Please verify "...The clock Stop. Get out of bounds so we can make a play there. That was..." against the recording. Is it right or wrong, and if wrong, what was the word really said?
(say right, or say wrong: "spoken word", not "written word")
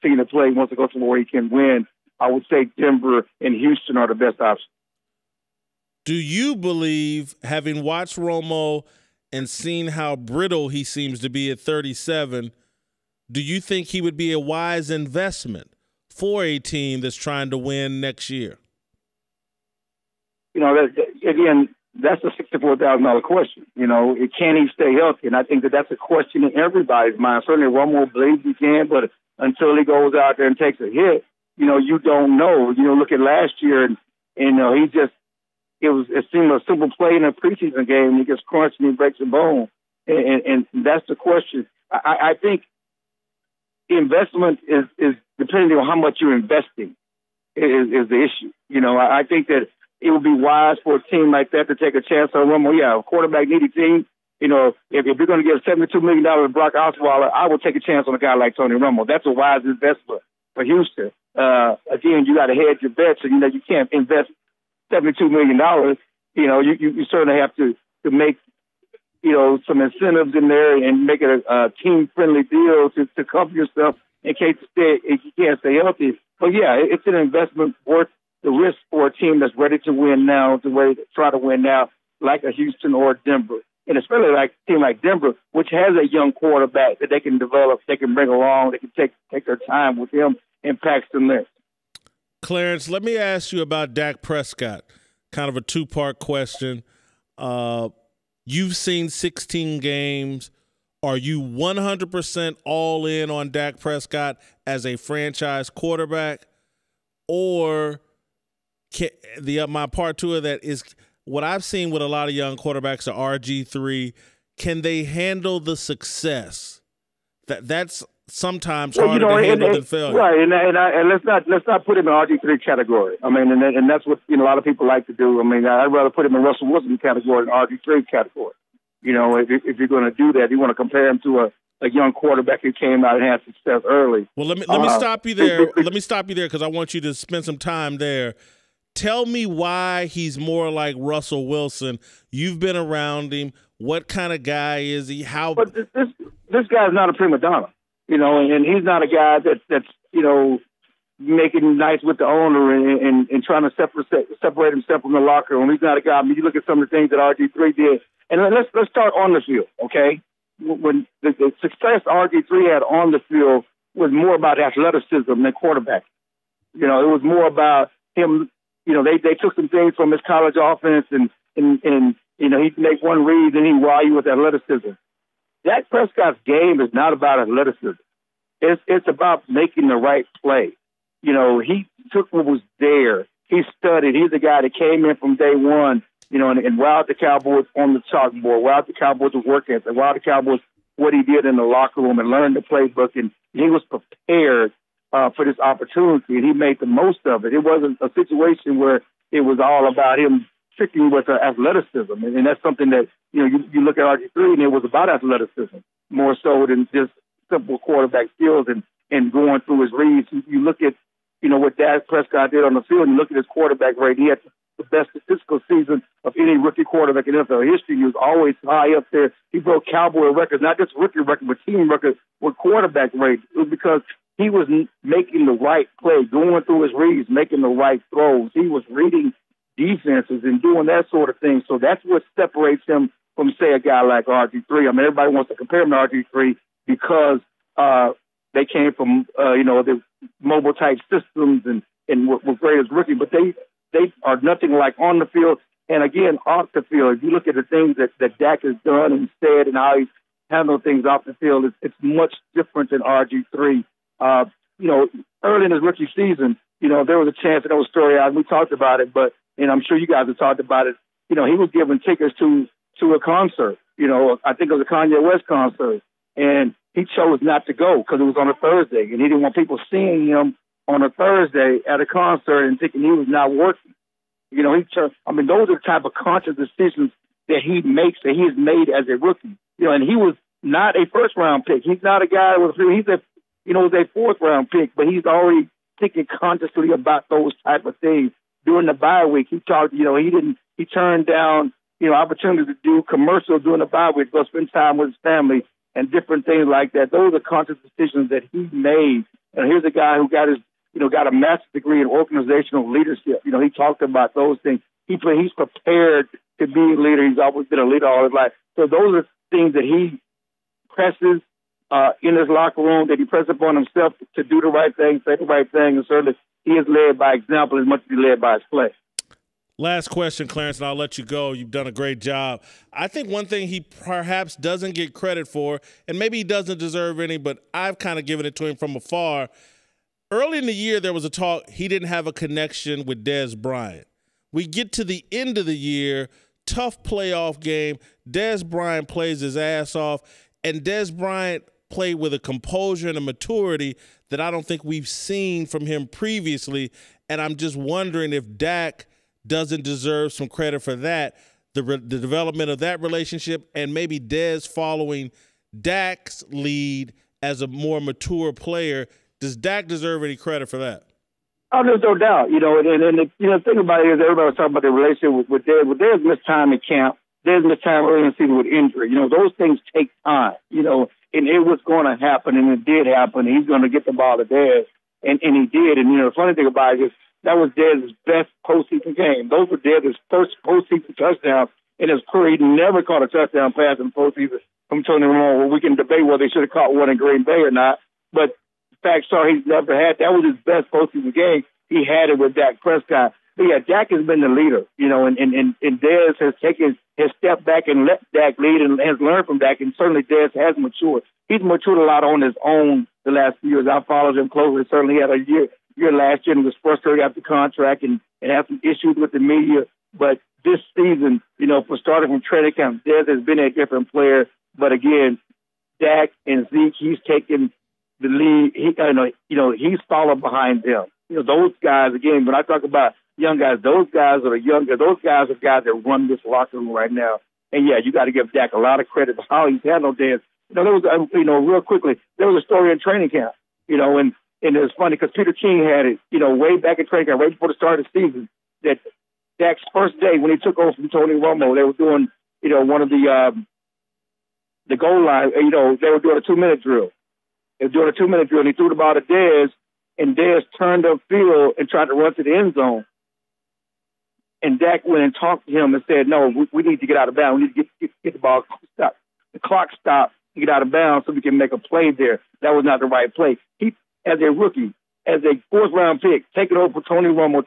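right.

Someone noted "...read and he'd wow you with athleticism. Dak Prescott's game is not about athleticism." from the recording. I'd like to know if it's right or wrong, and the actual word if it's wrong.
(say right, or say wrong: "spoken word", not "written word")
right.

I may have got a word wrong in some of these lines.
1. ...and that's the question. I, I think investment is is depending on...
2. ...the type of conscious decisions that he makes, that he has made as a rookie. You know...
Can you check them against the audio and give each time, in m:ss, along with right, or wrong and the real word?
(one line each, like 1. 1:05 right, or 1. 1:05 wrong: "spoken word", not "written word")
1. 0:40 right
2. 4:35 right.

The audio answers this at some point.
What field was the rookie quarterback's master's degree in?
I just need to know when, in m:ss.
5:02.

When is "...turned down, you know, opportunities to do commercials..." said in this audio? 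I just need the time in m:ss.
4:50.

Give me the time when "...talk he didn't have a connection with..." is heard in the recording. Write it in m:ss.
5:31.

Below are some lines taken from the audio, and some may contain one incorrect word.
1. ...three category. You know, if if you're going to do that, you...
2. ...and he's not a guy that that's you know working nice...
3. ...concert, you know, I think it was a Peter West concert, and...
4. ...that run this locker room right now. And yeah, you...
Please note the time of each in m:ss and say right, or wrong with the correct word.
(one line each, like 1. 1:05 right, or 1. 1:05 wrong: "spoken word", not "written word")
1. 2:07 right
2. 2:28 wrong: "making", not "working"
3. 4:23 wrong: "Kanye", not "Peter"
4. 7:05 right.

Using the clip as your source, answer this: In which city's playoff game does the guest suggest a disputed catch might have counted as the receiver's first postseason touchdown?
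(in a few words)
Green Bay.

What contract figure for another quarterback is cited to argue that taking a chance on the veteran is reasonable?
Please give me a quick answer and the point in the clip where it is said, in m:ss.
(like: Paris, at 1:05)
$72 million, at 0:55.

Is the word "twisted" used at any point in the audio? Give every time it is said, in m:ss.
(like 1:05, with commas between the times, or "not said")
not said.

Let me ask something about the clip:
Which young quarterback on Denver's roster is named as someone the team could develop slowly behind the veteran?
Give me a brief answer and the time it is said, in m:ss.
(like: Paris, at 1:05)
Paxton Lynch, at 1:30.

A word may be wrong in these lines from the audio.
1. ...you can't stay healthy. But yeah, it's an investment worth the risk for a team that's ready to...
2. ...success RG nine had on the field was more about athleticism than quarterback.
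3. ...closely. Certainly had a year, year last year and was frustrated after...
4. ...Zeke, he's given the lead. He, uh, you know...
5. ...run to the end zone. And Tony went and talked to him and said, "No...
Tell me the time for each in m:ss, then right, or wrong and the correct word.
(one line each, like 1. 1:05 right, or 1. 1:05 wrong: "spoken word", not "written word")
1. 1:15 right
2. 2:41 wrong: "three", not "nine"
3. 6:44 right
4. 6:56 wrong: "taken", not "given"
5. 7:32 wrong: "Dak", not "Tony".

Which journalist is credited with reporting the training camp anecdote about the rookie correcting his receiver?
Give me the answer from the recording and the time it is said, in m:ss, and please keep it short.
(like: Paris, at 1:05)
Peter King, at 7:15.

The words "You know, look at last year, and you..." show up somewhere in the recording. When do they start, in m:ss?
0:32.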